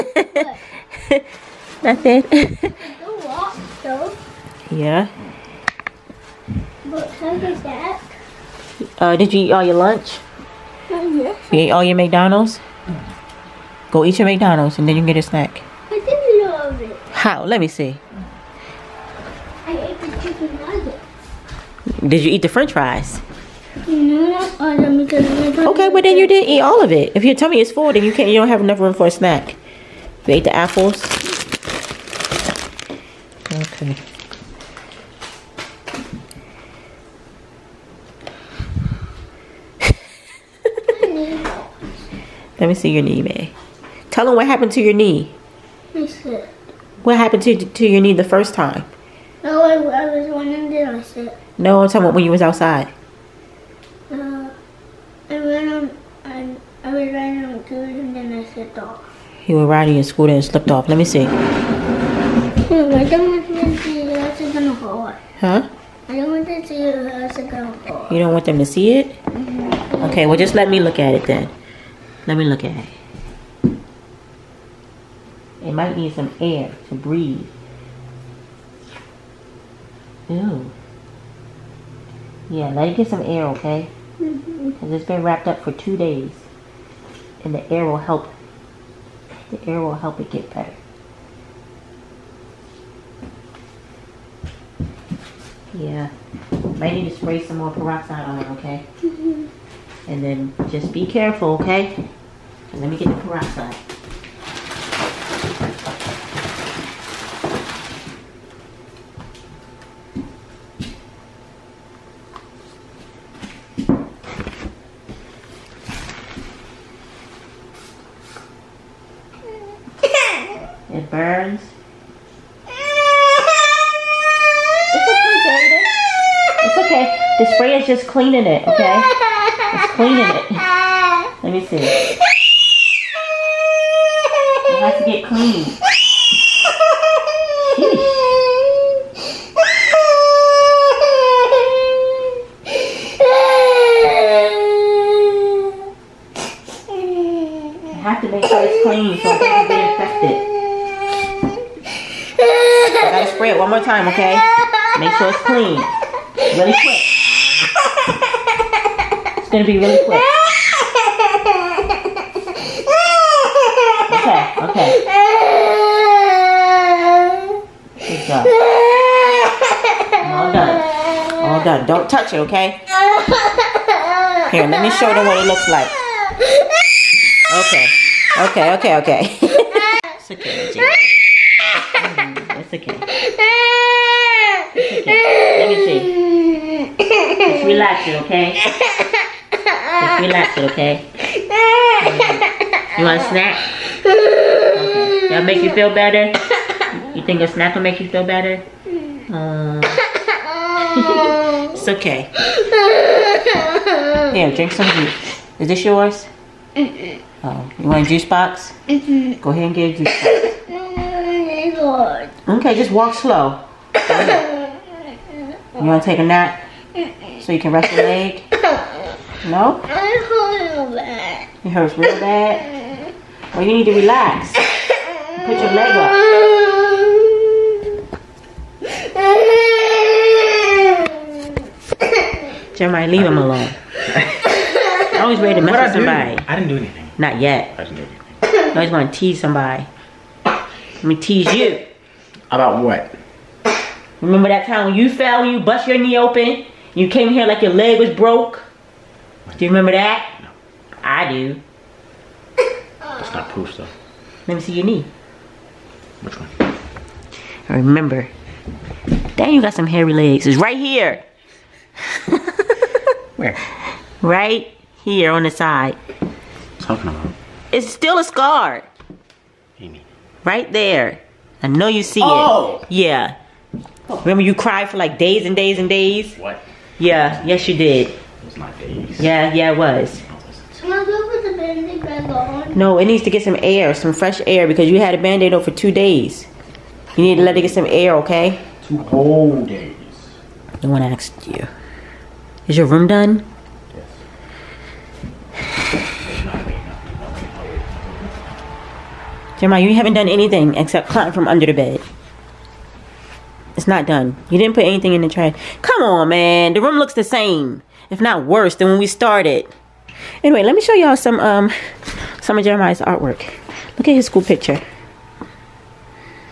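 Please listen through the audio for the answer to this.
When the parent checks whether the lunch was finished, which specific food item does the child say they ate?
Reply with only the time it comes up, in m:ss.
0:20.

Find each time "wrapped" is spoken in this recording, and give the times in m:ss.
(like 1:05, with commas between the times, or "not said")
1:25.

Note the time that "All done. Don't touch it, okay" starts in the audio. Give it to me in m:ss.
2:51.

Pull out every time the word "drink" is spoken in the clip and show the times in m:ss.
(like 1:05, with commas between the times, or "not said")
3:24.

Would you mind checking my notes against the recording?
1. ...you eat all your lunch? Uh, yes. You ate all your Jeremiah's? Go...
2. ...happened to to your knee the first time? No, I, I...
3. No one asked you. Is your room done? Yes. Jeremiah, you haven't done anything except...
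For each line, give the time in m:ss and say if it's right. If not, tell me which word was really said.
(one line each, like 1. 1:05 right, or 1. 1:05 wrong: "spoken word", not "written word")
1. 0:09 wrong: "McDonald", not "Jeremiah"
2. 0:47 right
3. 4:50 right.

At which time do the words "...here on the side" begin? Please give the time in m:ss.
4:25.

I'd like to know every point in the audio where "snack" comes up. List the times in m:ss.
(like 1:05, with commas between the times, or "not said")
0:15, 0:29, 3:13, 3:17.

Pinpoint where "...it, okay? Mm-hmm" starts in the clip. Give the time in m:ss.
1:38.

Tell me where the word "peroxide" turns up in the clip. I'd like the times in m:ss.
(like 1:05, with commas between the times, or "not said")
1:37, 1:43.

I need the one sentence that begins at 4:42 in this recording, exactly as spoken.
No, it needs to get some air, some fresh air, because you had a band-aid on for two days.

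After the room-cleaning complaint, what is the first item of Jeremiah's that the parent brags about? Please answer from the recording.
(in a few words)
school picture.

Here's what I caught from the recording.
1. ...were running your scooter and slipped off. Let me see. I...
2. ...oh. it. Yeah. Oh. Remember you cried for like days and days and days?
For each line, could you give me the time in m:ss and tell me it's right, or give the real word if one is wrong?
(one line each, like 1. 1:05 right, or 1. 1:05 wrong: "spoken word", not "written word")
1. 0:59 wrong: "riding", not "running"
2. 4:32 right.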